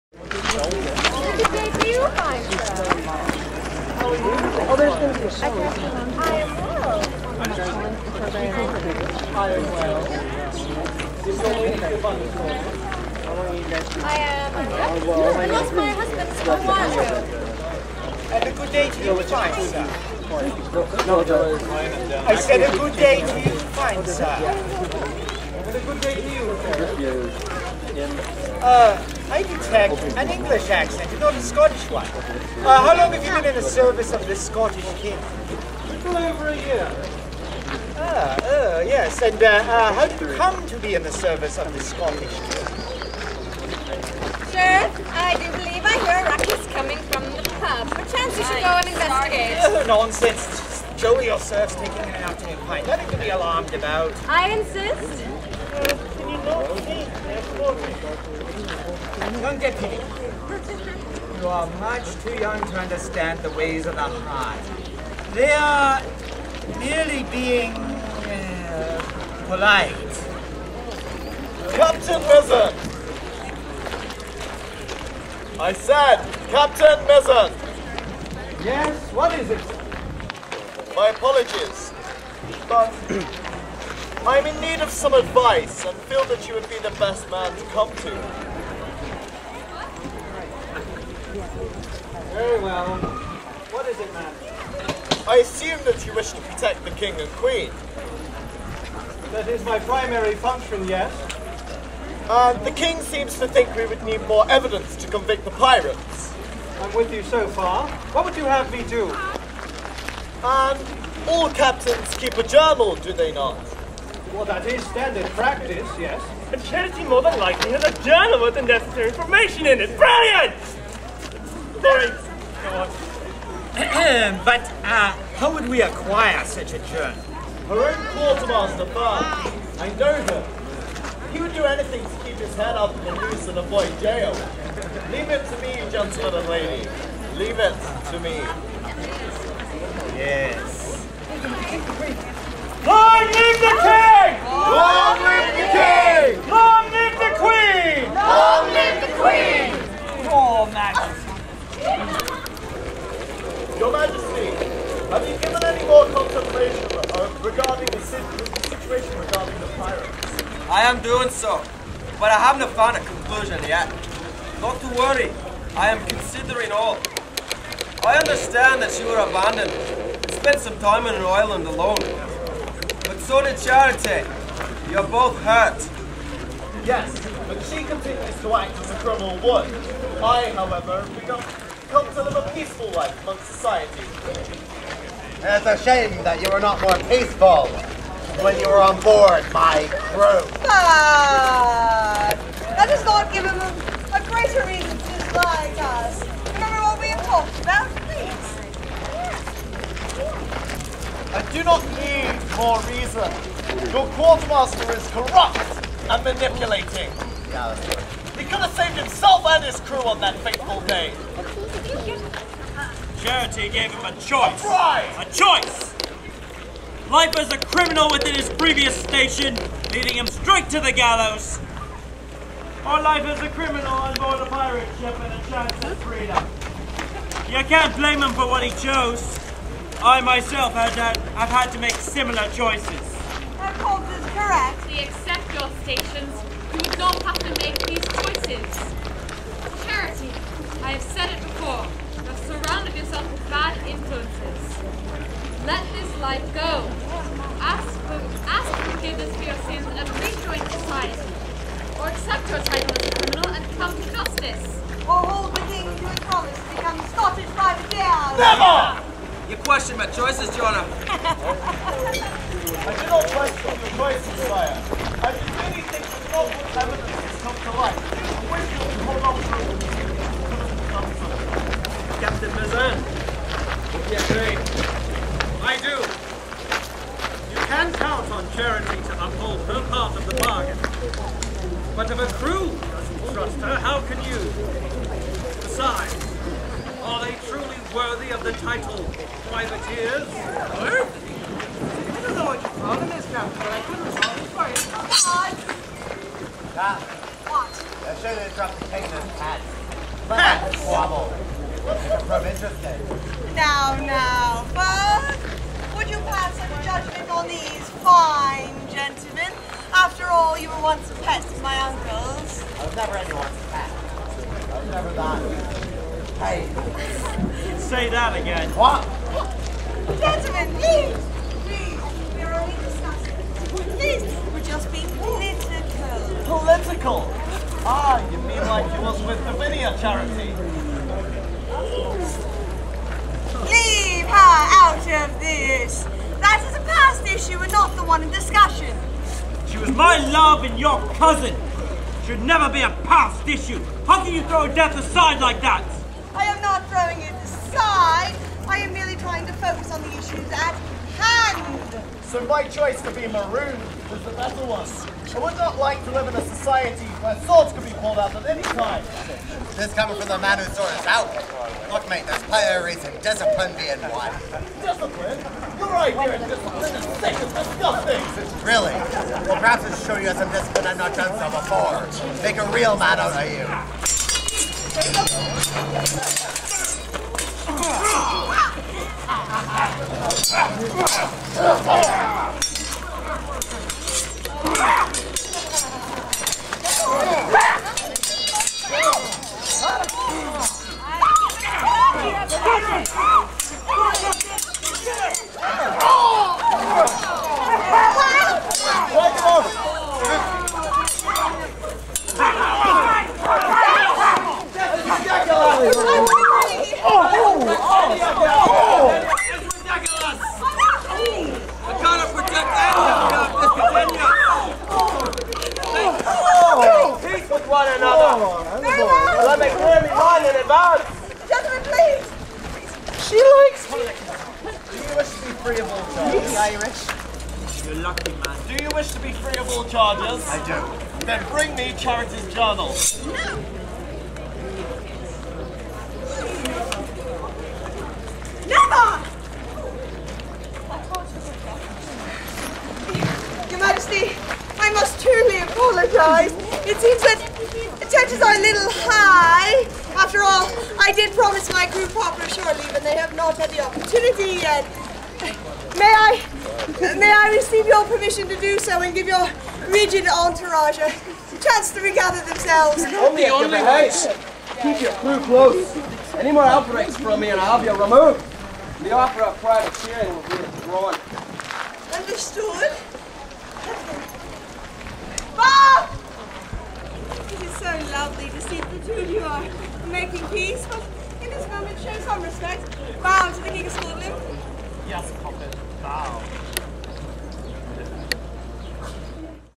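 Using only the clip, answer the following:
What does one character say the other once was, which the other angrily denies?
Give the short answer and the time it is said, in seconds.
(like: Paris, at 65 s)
Pets, at 311 s.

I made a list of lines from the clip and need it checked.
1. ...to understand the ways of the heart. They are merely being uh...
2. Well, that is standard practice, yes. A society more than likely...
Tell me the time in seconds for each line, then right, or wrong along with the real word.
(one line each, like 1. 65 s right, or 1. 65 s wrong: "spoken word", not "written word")
1. 62 s right
2. 114 s wrong: "charity", not "society".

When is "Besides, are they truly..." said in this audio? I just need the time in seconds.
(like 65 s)
285 s.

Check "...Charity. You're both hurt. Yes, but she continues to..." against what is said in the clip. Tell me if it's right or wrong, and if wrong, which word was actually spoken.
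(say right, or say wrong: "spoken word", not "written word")
right.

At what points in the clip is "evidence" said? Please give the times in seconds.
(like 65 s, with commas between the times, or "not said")
104 s, 266 s.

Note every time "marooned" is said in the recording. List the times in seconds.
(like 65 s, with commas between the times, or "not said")
353 s.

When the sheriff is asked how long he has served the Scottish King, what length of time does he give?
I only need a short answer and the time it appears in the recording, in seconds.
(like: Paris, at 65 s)
Little over a year, at 35 s.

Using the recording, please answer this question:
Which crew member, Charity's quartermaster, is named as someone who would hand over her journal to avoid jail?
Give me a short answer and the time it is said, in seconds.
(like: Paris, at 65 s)
Bart, at 128 s.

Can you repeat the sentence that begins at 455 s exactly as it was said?
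May I, may I receive your permission to do so and give your rigid entourage a chance to regather themselves?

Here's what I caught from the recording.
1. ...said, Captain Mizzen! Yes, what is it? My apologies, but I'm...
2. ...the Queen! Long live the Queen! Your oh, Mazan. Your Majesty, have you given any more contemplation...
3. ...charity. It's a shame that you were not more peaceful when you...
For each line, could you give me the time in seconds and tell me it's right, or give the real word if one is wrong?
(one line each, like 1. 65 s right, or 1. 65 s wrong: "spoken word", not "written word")
1. 75 s right
2. 147 s wrong: "Majesty", not "Mazan"
3. 183 s wrong: "society", not "charity".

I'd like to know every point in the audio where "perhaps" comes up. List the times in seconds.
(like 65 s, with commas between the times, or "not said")
369 s.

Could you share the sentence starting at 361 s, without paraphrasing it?
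Look, mate, there's priorities in discipline being one.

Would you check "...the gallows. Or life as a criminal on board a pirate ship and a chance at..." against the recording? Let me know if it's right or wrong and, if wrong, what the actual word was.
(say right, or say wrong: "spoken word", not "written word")
right.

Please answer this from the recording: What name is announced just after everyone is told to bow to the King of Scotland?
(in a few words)
Matthias Koppel.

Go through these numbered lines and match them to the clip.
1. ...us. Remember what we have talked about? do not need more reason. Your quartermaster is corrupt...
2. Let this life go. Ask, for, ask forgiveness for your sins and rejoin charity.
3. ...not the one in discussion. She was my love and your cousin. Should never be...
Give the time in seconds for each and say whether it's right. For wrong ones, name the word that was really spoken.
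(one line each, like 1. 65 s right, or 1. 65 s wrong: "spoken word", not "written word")
1. 195 s right
2. 245 s wrong: "society", not "charity"
3. 337 s right.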